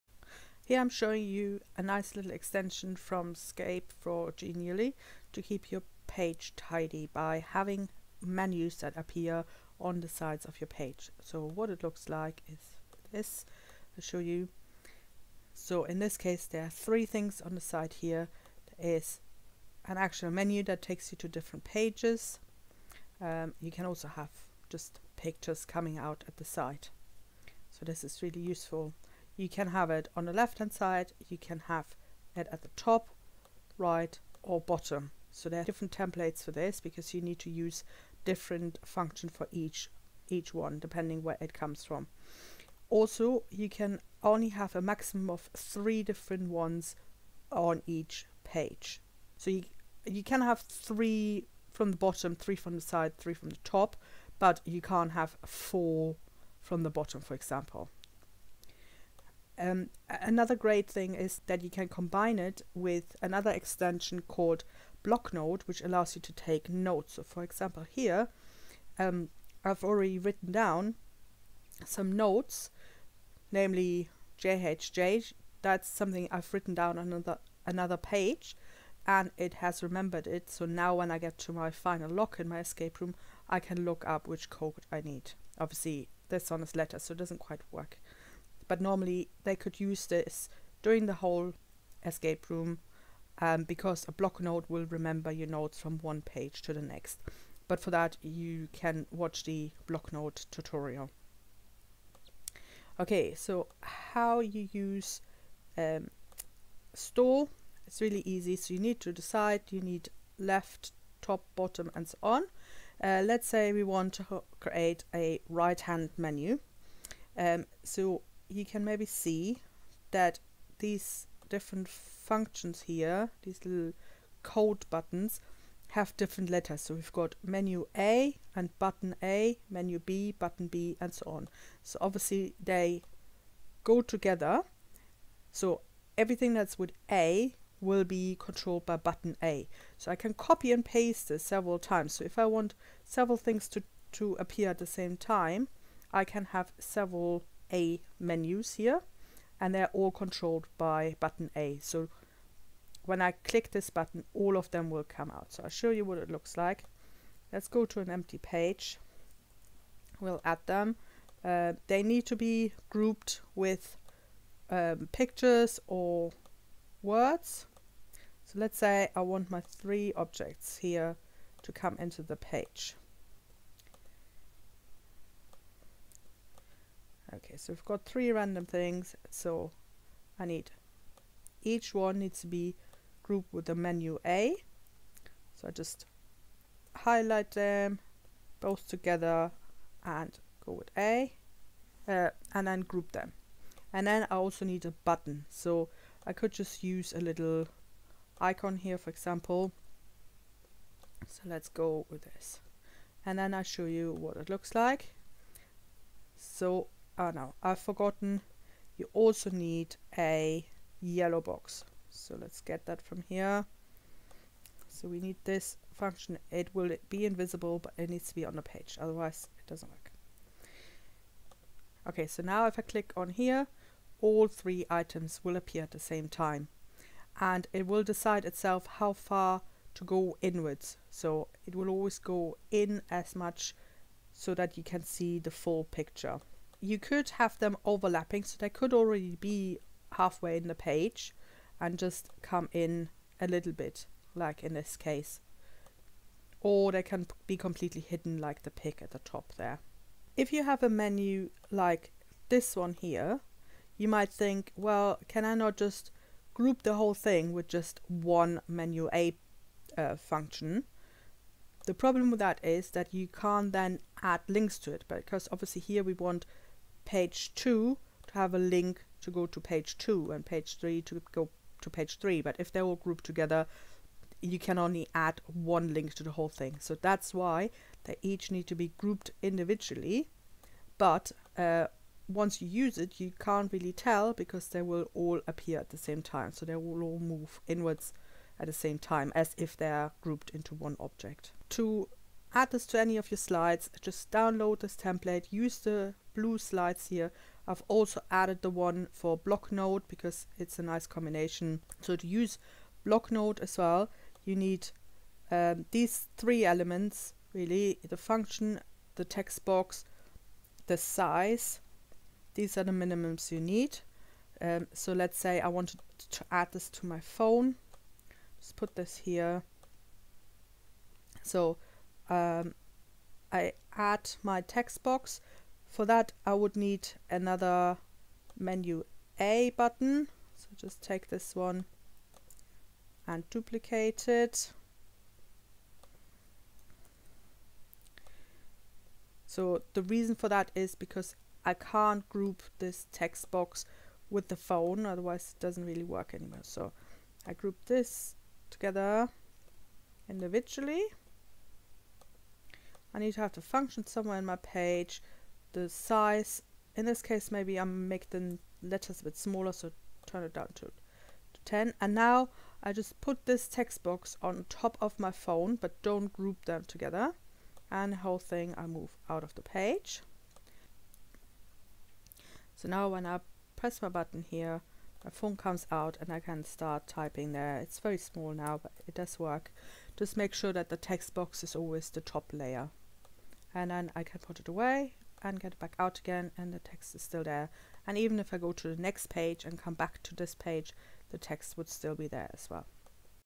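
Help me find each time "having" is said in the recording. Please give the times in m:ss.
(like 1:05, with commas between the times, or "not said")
0:07.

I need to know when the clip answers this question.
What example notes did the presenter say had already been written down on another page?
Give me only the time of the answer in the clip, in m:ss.
1:14.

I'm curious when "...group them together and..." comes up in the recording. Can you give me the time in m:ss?
6:06.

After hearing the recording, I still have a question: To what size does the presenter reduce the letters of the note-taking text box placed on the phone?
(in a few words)
10.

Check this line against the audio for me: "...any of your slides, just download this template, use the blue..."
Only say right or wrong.
right.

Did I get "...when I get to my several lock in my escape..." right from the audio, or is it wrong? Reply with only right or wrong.
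wrong.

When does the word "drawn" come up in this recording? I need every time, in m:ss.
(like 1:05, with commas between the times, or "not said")
not said.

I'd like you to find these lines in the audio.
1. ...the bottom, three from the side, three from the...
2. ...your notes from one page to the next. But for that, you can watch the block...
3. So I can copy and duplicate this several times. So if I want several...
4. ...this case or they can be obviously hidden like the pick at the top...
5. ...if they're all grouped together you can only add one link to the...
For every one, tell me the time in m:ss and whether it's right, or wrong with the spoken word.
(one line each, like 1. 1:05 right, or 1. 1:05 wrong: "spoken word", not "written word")
1. 0:51 right
2. 1:35 right
3. 2:19 wrong: "paste", not "duplicate"
4. 4:04 wrong: "completely", not "obviously"
5. 4:32 right.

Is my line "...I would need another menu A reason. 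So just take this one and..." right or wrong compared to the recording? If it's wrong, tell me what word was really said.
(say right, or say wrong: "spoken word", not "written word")
wrong: "button", not "reason".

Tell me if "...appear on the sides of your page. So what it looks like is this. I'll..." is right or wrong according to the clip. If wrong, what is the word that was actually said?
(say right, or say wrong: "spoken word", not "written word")
right.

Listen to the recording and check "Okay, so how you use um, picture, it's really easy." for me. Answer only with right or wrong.
wrong.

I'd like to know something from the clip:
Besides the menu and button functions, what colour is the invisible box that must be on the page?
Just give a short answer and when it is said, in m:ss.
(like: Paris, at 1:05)
Yellow, at 3:31.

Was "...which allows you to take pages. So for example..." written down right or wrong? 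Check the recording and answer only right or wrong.
wrong.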